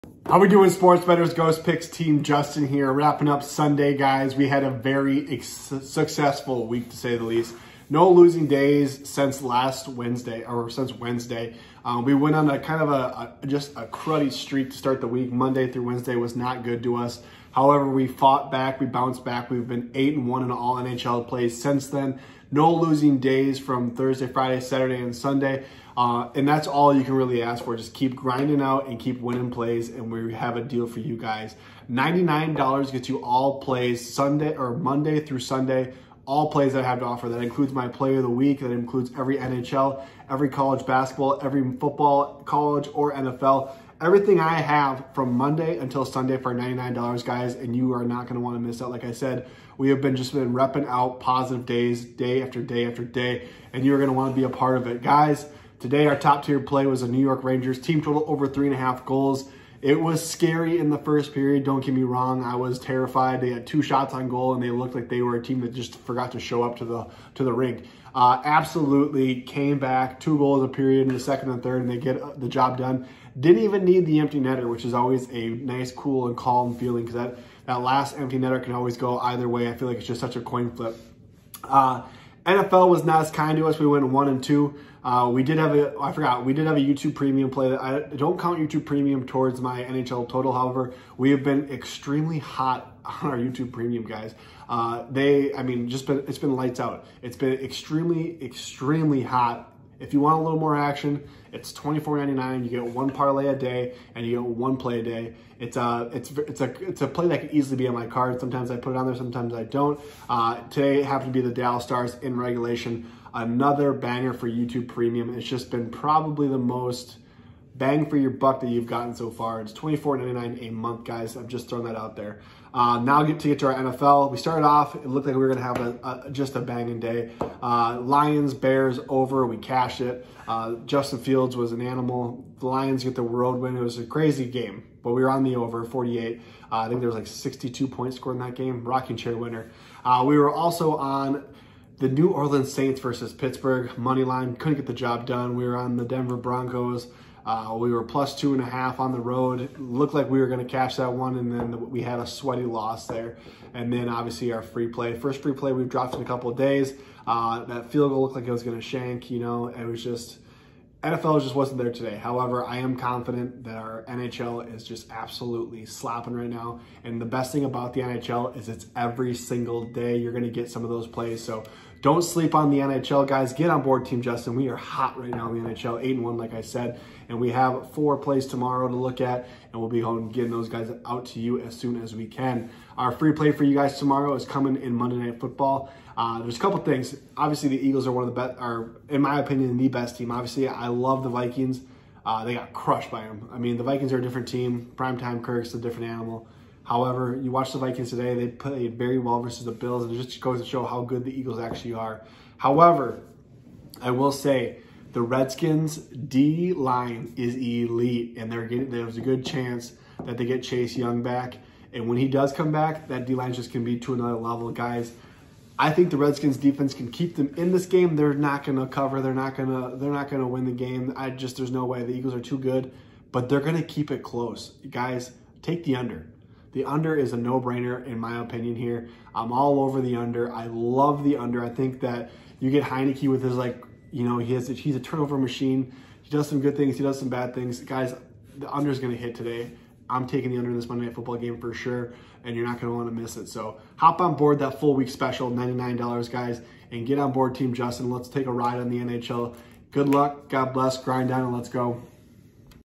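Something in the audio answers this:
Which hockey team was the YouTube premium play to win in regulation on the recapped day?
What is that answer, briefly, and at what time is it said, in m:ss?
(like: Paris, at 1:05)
Dallas Stars, at 1:51.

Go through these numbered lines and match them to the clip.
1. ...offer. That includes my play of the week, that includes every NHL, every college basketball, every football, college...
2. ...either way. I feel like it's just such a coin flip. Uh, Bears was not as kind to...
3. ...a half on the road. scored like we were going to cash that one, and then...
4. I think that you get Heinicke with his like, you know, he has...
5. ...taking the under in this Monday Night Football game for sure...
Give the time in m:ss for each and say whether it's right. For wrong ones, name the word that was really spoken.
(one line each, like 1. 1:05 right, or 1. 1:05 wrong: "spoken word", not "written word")
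1. 0:37 right
2. 1:19 wrong: "NFL", not "Bears"
3. 2:28 wrong: "looked", not "scored"
4. 3:51 right
5. 4:00 right.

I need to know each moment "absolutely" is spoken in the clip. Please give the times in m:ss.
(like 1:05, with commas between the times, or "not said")
1:08, 2:45.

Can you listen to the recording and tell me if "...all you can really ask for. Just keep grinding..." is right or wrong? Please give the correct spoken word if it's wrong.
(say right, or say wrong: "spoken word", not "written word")
right.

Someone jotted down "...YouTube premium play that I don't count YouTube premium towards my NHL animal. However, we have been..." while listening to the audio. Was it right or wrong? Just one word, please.
wrong.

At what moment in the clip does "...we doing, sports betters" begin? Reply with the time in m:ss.
0:00.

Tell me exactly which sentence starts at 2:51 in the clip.
So don't sleep on the NHL, guys.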